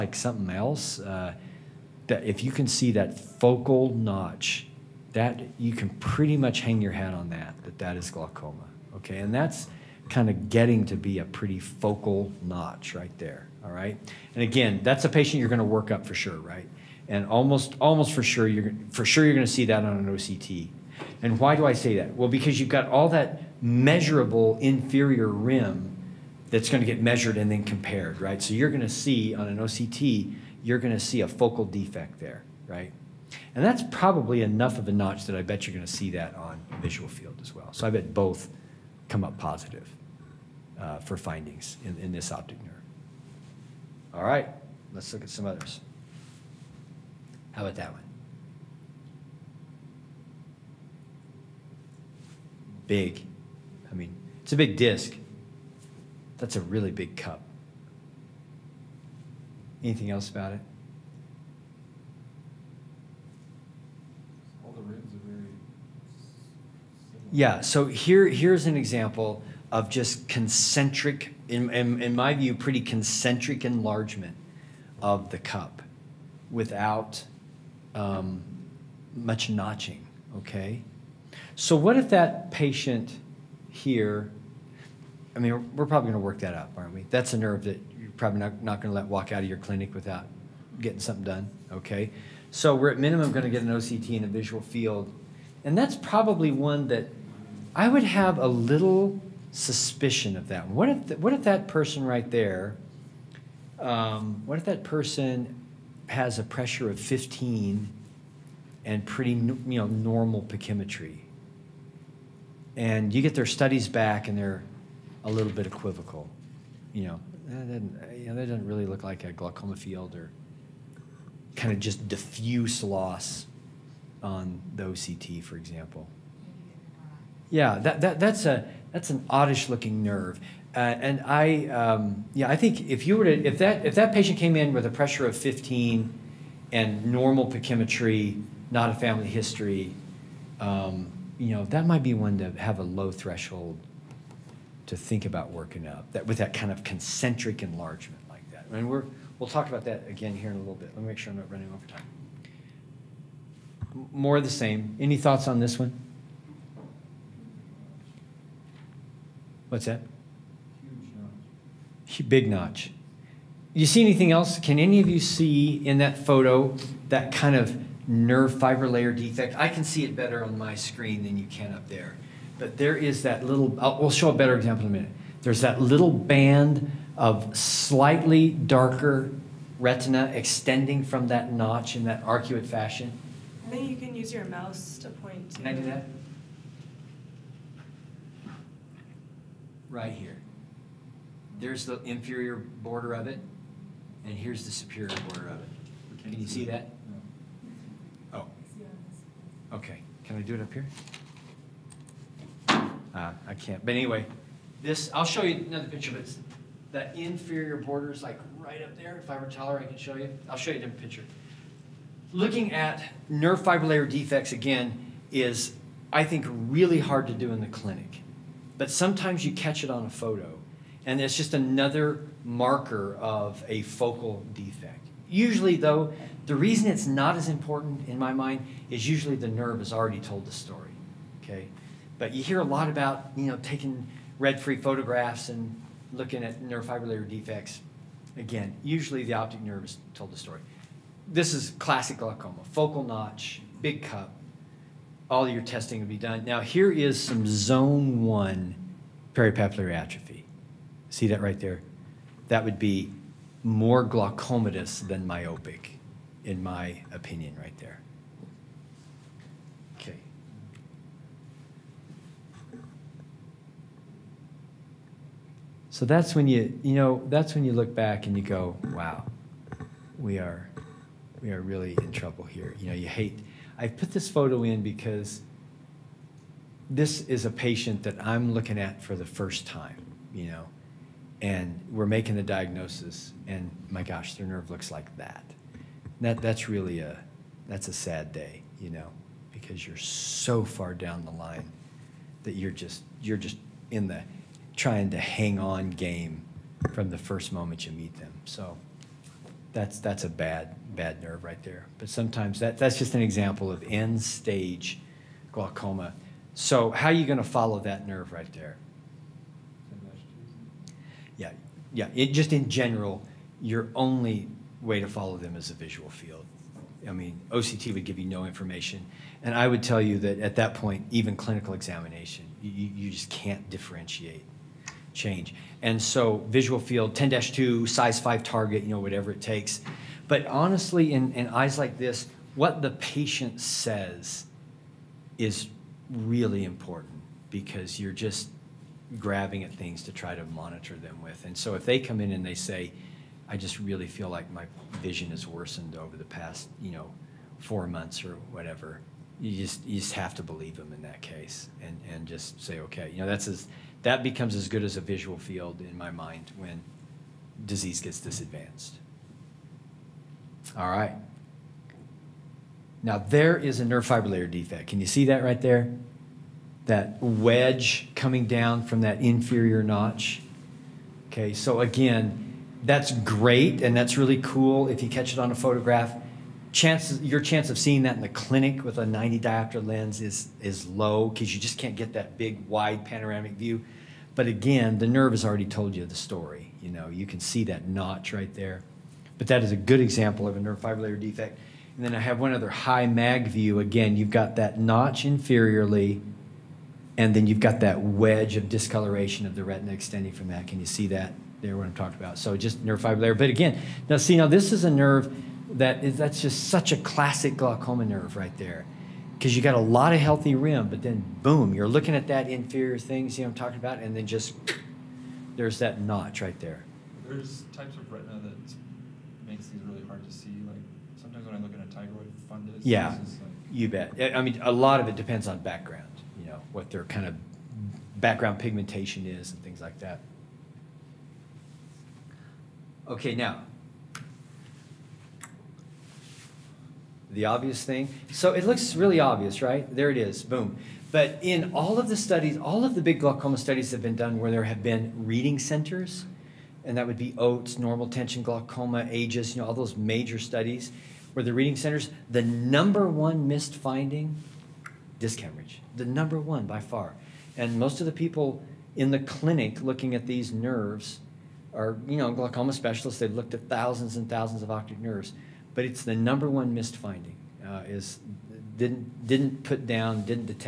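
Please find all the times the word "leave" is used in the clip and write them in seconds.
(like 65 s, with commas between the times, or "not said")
not said.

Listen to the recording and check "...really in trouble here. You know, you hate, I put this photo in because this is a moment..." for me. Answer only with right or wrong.
wrong.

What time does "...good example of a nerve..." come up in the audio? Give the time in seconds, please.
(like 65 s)
389 s.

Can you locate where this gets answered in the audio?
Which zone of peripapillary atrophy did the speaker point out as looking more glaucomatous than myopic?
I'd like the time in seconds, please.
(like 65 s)
247 s.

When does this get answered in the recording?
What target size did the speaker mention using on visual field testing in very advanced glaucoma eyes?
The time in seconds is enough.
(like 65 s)
327 s.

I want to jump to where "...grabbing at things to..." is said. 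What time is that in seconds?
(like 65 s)
339 s.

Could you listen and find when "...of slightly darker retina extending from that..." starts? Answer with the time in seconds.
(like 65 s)
177 s.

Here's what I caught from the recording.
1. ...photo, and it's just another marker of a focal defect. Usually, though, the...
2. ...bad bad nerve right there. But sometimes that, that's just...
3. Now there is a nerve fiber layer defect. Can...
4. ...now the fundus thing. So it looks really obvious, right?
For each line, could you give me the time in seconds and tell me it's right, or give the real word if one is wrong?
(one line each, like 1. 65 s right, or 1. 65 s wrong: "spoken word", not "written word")
1. 220 s right
2. 300 s right
3. 363 s right
4. 433 s wrong: "obvious", not "fundus".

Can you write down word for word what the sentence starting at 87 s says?
That's a nerve that you're probably not, not going to let walk out of your clinic without getting something done.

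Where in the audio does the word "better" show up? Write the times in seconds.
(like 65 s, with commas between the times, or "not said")
170 s, 174 s.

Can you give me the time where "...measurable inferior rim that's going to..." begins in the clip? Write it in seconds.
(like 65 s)
23 s.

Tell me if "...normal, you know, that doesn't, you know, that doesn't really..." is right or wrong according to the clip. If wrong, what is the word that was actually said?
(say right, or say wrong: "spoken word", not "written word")
wrong: "equivocal", not "normal".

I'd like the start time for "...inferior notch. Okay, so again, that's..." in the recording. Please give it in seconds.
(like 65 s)
369 s.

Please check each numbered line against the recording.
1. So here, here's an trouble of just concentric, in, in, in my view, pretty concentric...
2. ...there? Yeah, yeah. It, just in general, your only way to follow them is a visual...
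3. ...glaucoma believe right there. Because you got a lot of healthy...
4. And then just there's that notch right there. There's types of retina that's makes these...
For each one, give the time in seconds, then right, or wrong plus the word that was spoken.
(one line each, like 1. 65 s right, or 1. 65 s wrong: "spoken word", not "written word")
1. 67 s wrong: "example", not "trouble"
2. 308 s right
3. 407 s wrong: "nerve", not "believe"
4. 414 s right.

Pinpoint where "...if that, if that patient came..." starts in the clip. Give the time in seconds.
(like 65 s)
133 s.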